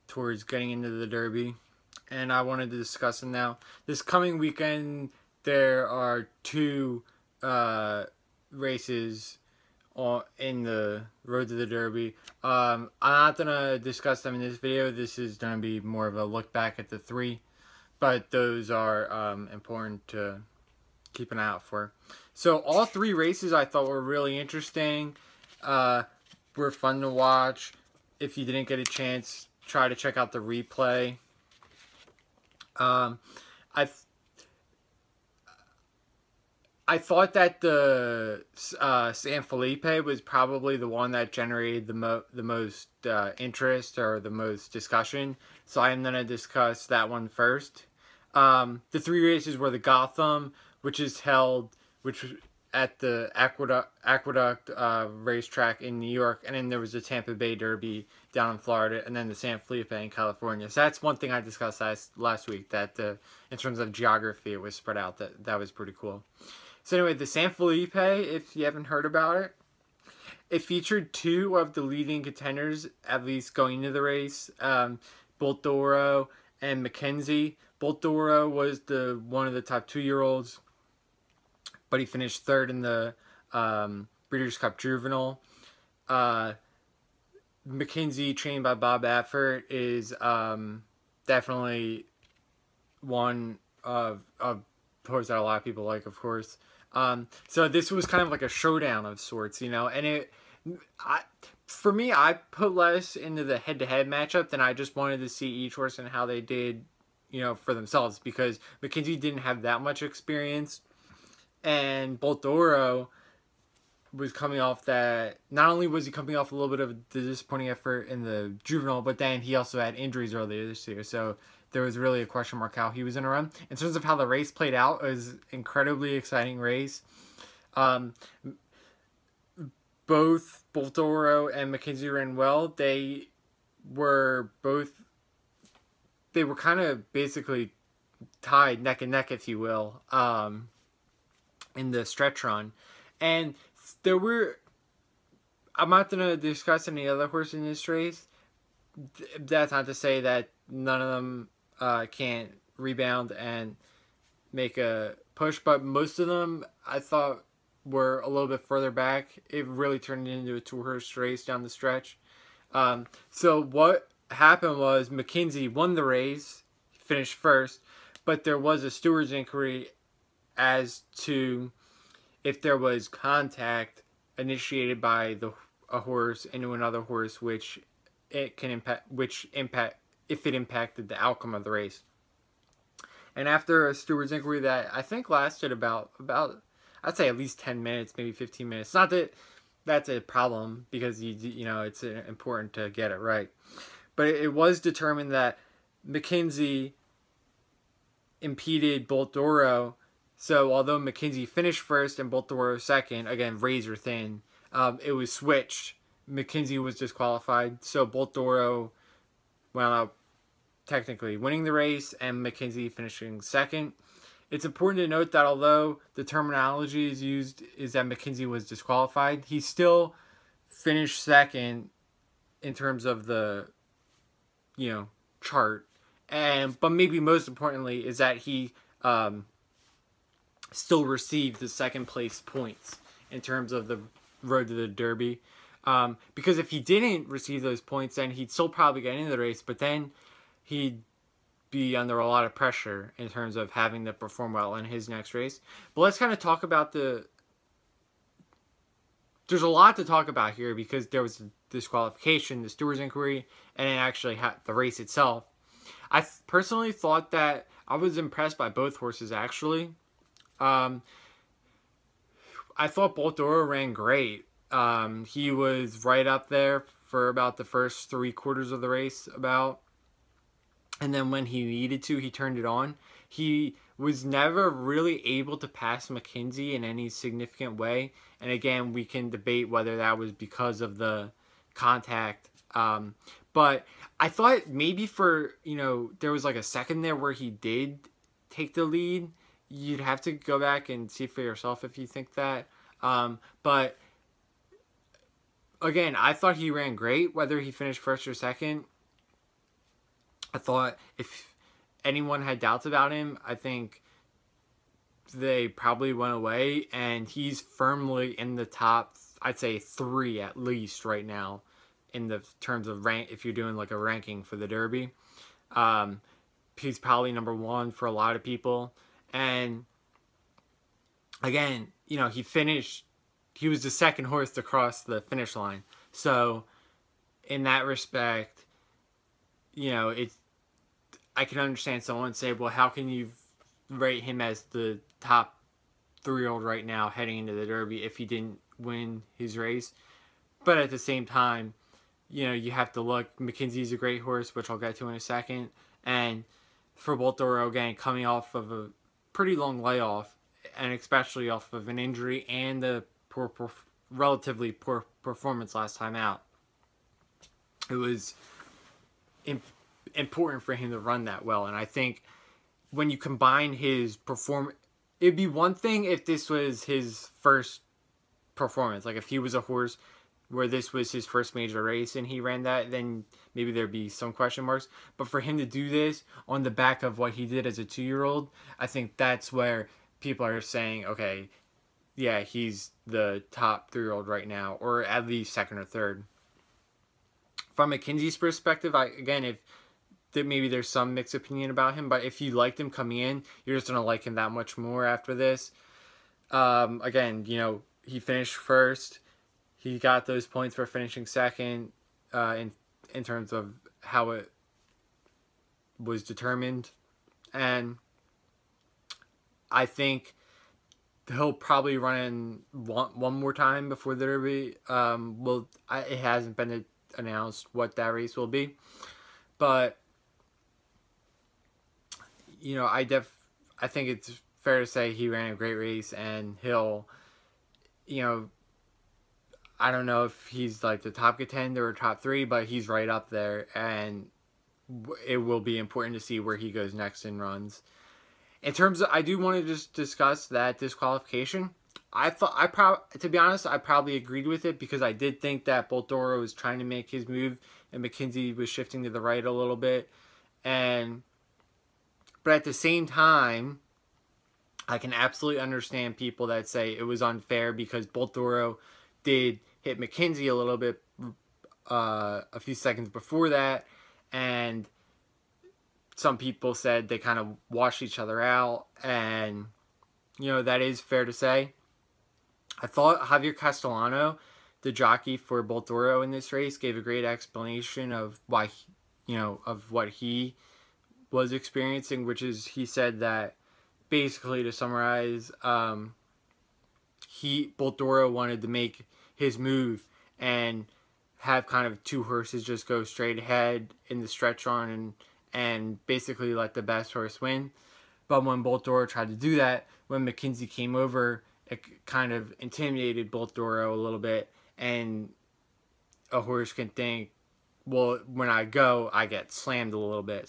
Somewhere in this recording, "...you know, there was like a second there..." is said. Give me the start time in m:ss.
4:45.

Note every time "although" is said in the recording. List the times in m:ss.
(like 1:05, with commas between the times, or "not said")
3:20, 3:35.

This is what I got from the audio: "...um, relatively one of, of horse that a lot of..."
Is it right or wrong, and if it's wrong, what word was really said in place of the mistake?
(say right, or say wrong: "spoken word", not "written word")
wrong: "definitely", not "relatively".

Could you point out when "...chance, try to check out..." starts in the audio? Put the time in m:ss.
0:28.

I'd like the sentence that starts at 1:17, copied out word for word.
Dora was the one of the top two-year-olds, but he finished third in the um, Breeders' Cup Juvenile.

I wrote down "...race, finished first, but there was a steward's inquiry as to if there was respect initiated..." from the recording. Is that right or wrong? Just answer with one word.
wrong.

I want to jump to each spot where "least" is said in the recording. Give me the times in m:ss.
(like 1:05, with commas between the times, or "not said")
1:13, 3:07, 5:10, 6:25.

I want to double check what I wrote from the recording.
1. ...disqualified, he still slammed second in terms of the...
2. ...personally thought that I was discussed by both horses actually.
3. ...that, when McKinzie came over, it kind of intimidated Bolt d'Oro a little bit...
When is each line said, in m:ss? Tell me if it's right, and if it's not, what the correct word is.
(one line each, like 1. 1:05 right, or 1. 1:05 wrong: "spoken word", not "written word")
1. 3:38 wrong: "finished", not "slammed"
2. 4:16 wrong: "impressed", not "discussed"
3. 8:19 right.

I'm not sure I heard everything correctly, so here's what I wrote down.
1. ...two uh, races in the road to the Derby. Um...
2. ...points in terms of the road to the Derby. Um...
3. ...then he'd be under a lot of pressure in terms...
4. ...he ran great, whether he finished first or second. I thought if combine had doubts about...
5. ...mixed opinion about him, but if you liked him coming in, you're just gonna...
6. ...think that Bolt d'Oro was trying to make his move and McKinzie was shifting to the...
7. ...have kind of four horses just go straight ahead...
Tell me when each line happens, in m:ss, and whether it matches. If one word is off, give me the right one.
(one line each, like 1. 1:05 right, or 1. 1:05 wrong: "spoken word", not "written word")
1. 0:06 right
2. 3:52 right
3. 3:59 right
4. 4:56 wrong: "anyone", not "combine"
5. 6:31 right
6. 7:25 right
7. 8:11 wrong: "two", not "four".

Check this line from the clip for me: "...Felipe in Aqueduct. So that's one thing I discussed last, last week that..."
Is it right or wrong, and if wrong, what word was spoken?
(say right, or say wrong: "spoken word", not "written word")
wrong: "California", not "Aqueduct".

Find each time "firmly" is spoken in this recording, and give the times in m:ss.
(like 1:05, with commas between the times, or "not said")
5:07.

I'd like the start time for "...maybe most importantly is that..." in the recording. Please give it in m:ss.
3:46.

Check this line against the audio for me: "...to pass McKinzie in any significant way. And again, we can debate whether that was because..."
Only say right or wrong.
right.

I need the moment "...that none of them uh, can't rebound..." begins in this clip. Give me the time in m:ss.
2:30.